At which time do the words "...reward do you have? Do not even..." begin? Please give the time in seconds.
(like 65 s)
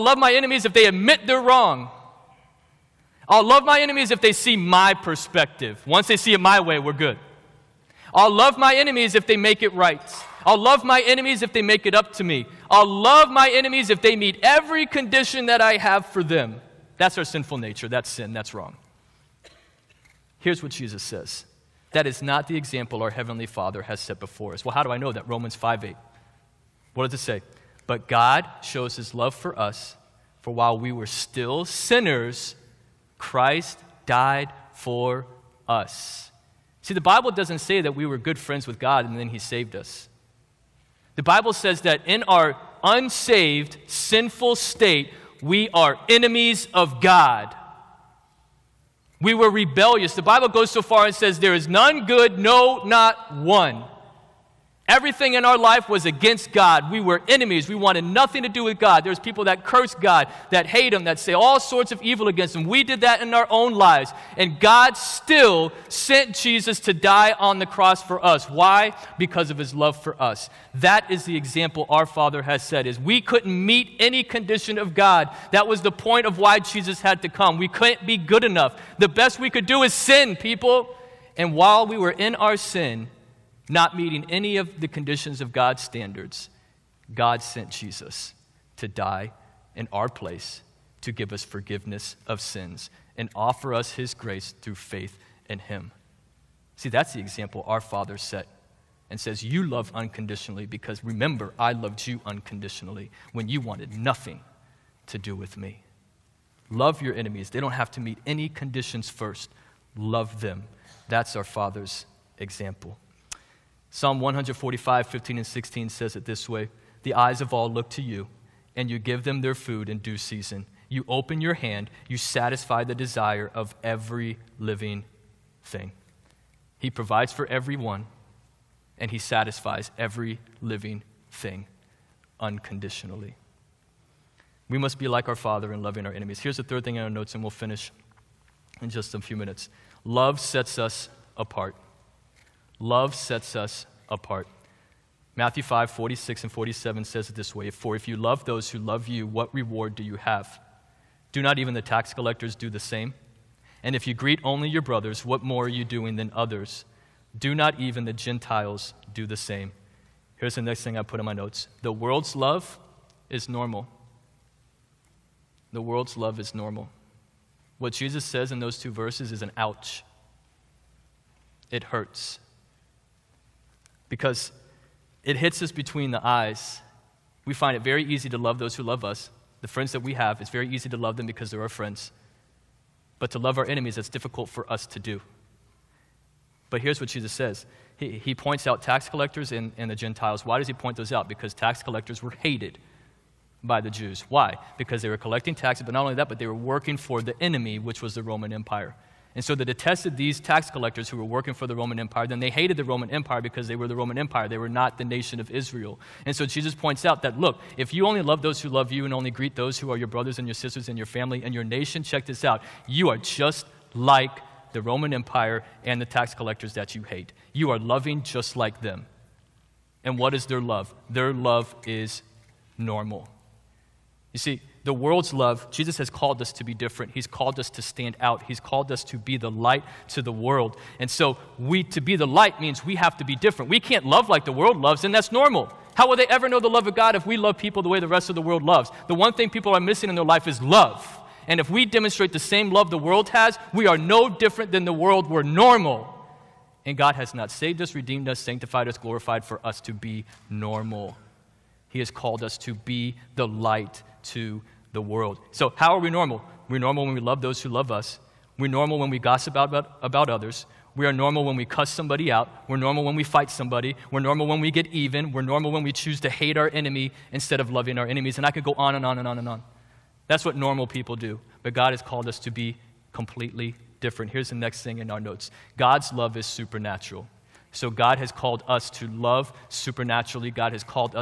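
149 s.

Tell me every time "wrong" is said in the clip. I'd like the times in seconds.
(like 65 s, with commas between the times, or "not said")
1 s, 18 s.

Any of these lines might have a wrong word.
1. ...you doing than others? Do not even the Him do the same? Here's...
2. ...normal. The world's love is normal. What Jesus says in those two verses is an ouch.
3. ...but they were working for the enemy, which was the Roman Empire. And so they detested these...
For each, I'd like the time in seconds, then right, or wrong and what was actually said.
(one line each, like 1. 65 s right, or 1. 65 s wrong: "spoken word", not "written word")
1. 155 s wrong: "Gentiles", not "Him"
2. 163 s right
3. 196 s right.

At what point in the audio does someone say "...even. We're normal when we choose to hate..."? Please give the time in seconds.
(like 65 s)
264 s.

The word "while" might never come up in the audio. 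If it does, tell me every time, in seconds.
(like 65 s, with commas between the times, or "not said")
30 s, 81 s.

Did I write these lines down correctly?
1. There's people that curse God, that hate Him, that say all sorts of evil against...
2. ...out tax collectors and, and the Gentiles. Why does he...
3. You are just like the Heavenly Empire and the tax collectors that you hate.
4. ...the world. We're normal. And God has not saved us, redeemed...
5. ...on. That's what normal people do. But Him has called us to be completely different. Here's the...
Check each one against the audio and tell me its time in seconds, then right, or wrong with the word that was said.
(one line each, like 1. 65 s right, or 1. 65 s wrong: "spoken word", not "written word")
1. 59 s right
2. 188 s right
3. 212 s wrong: "Roman", not "Heavenly"
4. 244 s right
5. 269 s wrong: "God", not "Him".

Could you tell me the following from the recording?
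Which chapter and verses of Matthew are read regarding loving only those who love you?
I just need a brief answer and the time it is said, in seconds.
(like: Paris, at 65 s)
Matthew 5:46-47, at 145 s.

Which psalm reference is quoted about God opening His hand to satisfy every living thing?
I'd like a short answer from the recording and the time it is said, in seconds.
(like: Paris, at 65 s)
Psalm 145:15-16, at 113 s.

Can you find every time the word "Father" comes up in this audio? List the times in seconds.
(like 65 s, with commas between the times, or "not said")
23 s, 72 s, 97 s, 111 s, 135 s.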